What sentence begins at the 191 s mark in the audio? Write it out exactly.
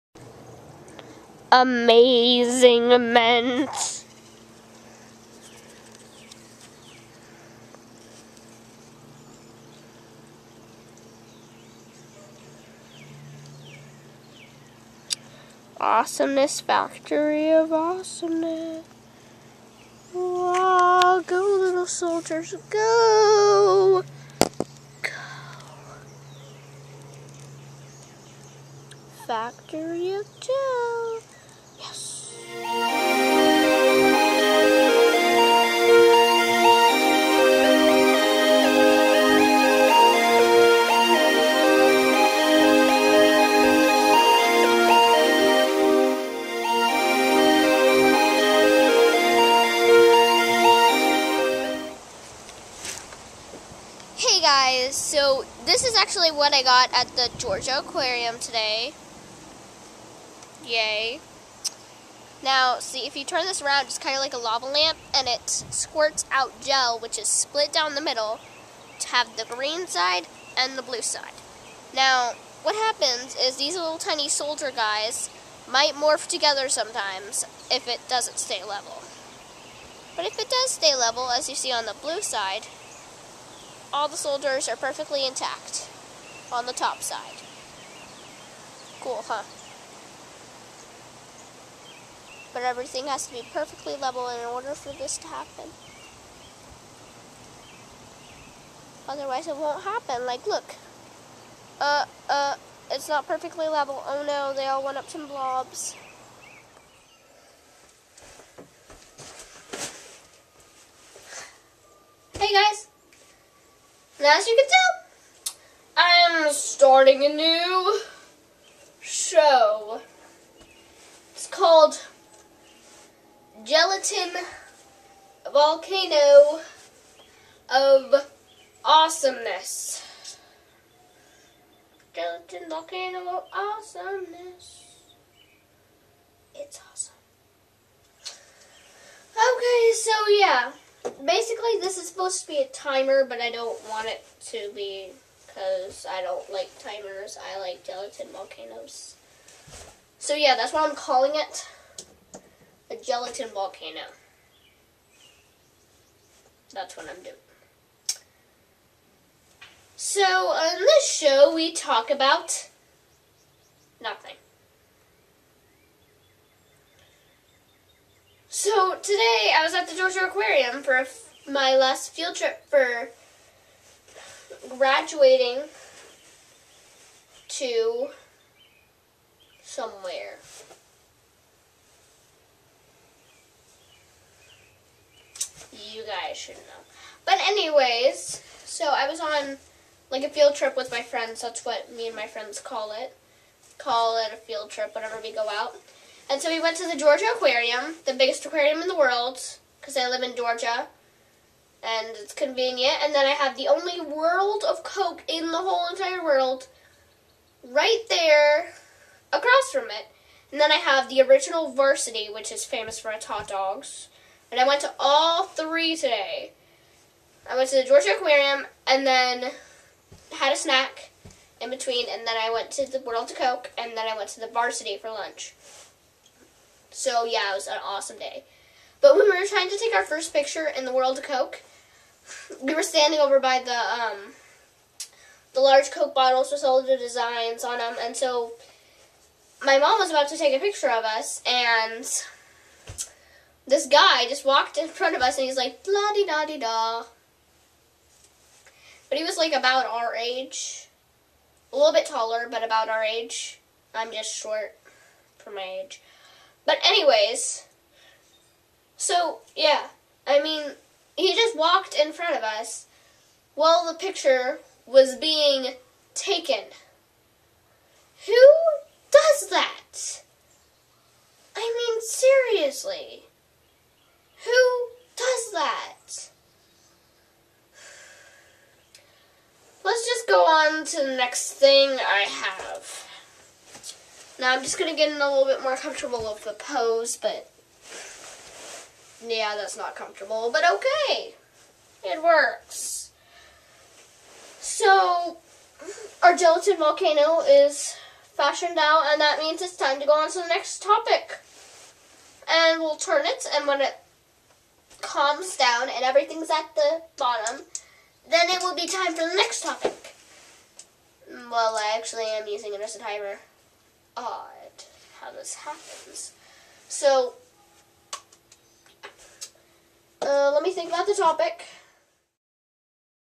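That's what me and my friends call it.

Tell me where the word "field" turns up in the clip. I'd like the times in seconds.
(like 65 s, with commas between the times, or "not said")
172 s, 190 s, 194 s.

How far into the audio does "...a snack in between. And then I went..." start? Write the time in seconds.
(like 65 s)
220 s.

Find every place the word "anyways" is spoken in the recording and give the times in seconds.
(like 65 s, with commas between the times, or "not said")
187 s, 256 s.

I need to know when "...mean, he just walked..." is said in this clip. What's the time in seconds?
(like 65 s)
260 s.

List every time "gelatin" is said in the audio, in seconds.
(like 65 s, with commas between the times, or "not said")
123 s, 132 s, 147 s, 152 s, 296 s.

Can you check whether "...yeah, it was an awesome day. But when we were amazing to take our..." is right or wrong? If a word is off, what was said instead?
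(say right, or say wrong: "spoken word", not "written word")
wrong: "trying", not "amazing".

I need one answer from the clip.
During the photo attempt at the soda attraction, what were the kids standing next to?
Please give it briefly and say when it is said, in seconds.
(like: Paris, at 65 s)
large Coke bottles, at 235 s.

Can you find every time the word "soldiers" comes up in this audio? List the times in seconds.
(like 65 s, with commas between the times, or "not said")
21 s, 74 s, 84 s.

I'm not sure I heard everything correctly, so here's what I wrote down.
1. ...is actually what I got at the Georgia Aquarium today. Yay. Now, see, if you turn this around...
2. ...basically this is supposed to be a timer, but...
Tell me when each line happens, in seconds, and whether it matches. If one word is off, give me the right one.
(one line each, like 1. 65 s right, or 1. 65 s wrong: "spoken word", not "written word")
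1. 55 s right
2. 141 s right.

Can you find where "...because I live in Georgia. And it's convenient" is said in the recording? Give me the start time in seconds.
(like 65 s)
199 s.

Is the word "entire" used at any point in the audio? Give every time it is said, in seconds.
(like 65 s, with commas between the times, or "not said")
205 s.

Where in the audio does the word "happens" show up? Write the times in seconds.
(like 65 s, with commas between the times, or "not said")
72 s, 95 s, 99 s, 315 s.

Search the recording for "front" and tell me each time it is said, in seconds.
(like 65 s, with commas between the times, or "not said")
244 s, 262 s.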